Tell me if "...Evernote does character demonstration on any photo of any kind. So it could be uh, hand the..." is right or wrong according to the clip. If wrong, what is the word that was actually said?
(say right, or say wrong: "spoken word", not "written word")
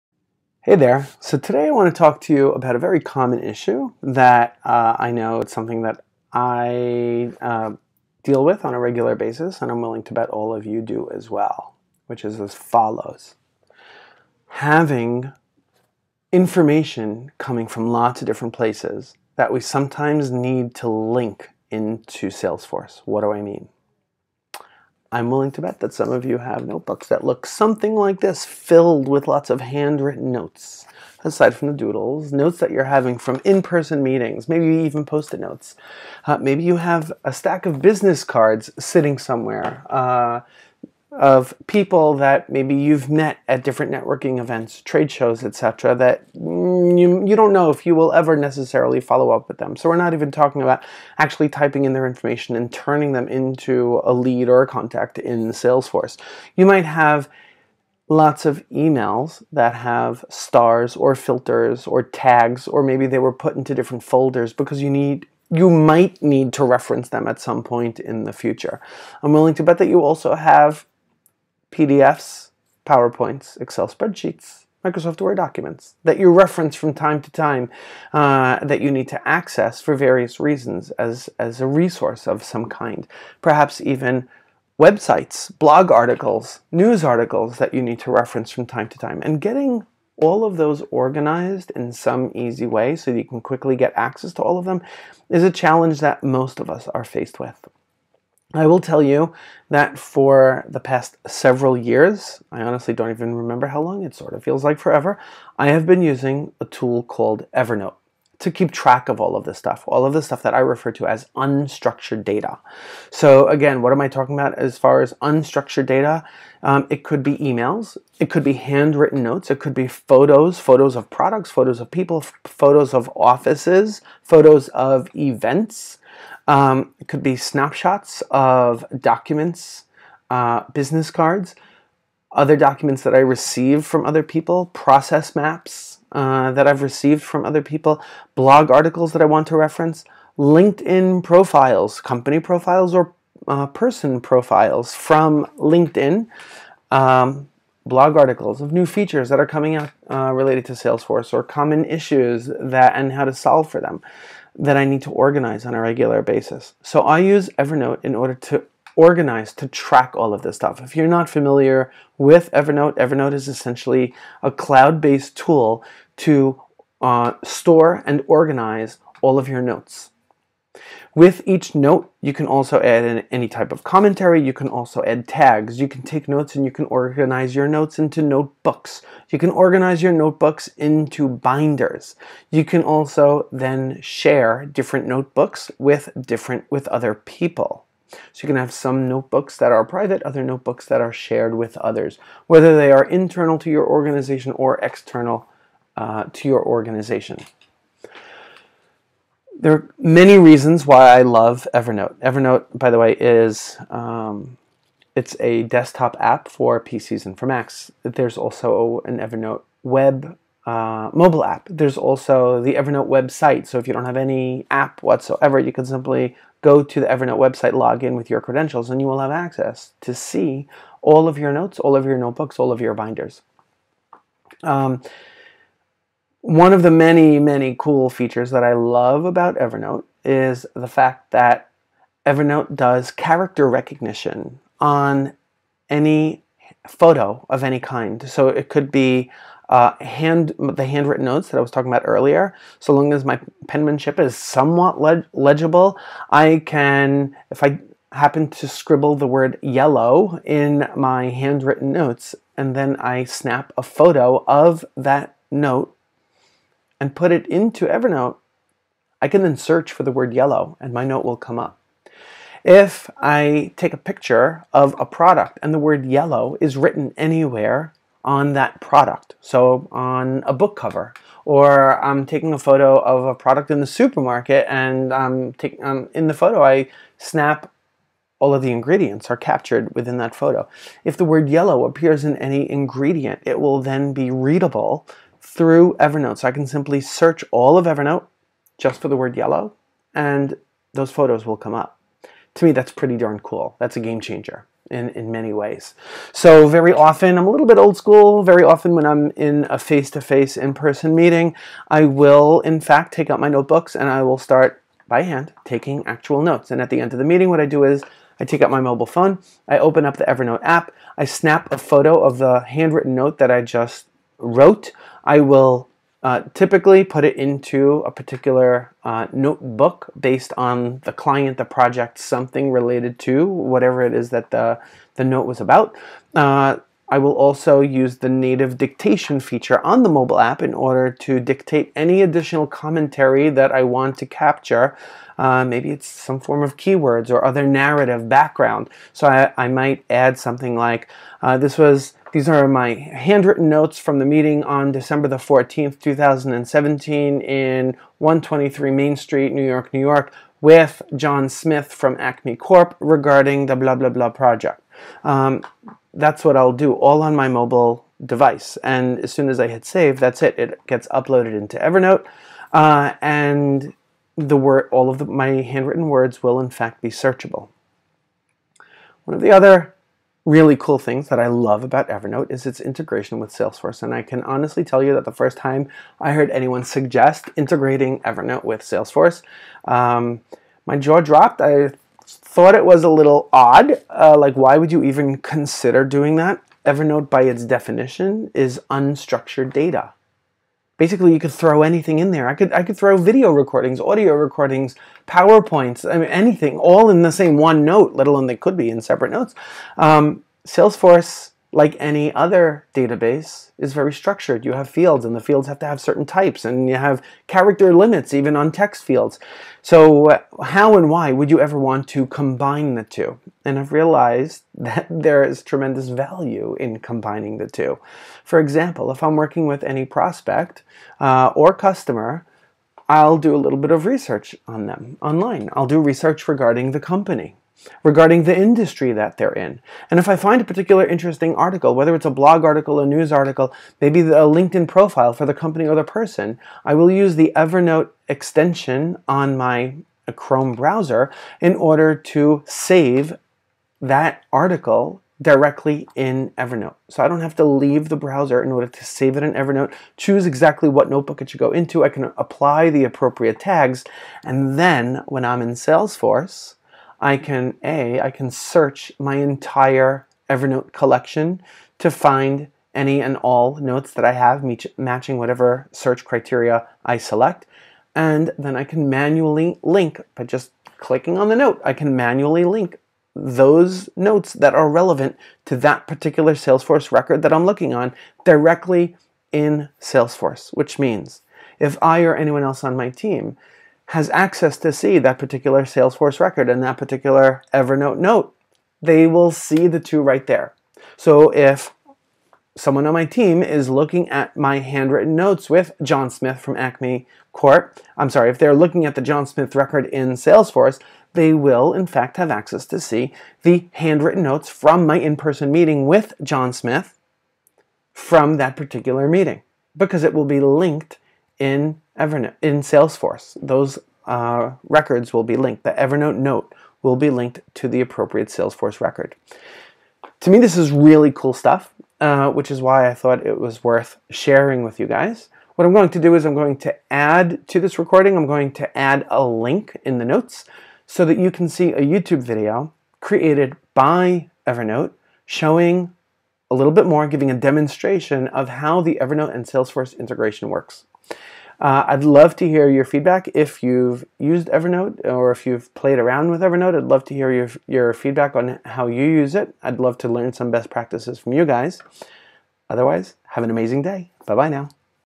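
wrong: "recognition", not "demonstration".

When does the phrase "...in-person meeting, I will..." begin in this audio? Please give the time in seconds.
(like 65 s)
300 s.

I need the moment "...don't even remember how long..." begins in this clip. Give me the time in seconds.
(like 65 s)
102 s.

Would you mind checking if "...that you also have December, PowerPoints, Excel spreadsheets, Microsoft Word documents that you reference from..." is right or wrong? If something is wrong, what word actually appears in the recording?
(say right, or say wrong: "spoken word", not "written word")
wrong: "PDFs", not "December".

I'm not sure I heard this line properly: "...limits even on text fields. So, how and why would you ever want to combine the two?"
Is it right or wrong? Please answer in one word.
right.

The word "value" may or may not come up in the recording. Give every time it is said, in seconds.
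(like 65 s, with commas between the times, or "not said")
416 s.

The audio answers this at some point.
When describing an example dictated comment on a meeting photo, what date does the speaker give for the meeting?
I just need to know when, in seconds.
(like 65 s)
344 s.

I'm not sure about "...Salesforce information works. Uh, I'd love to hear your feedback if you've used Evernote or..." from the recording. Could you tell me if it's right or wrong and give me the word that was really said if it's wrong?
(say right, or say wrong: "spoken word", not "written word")
wrong: "integration", not "information".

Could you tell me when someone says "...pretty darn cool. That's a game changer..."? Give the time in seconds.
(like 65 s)
292 s.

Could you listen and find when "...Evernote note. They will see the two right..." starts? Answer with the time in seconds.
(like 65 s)
487 s.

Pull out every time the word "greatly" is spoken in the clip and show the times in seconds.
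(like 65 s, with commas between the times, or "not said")
not said.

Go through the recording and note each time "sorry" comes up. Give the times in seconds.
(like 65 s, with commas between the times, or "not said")
498 s.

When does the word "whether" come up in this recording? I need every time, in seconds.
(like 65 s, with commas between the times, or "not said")
192 s, 431 s.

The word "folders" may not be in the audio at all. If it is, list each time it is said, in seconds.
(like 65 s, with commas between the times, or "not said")
64 s.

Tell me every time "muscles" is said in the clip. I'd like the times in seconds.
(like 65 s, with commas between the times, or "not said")
not said.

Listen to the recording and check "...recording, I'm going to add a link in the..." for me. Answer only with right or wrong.
right.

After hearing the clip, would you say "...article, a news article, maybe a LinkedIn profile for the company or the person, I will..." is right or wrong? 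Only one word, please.
right.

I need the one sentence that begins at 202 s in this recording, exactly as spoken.
Evernote, by the way, is um, it's a desktop app for PCs and for Macs.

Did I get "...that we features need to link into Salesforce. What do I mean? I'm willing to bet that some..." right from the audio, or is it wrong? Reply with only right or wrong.
wrong.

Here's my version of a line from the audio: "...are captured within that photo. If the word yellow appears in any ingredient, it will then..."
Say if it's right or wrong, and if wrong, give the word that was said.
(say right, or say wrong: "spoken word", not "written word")
right.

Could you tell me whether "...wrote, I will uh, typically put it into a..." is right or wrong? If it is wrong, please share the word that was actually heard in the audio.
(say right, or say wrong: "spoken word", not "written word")
right.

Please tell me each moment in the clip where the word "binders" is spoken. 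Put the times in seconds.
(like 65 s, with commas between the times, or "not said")
181 s, 222 s.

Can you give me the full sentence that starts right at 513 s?
Those uh, records will be linked.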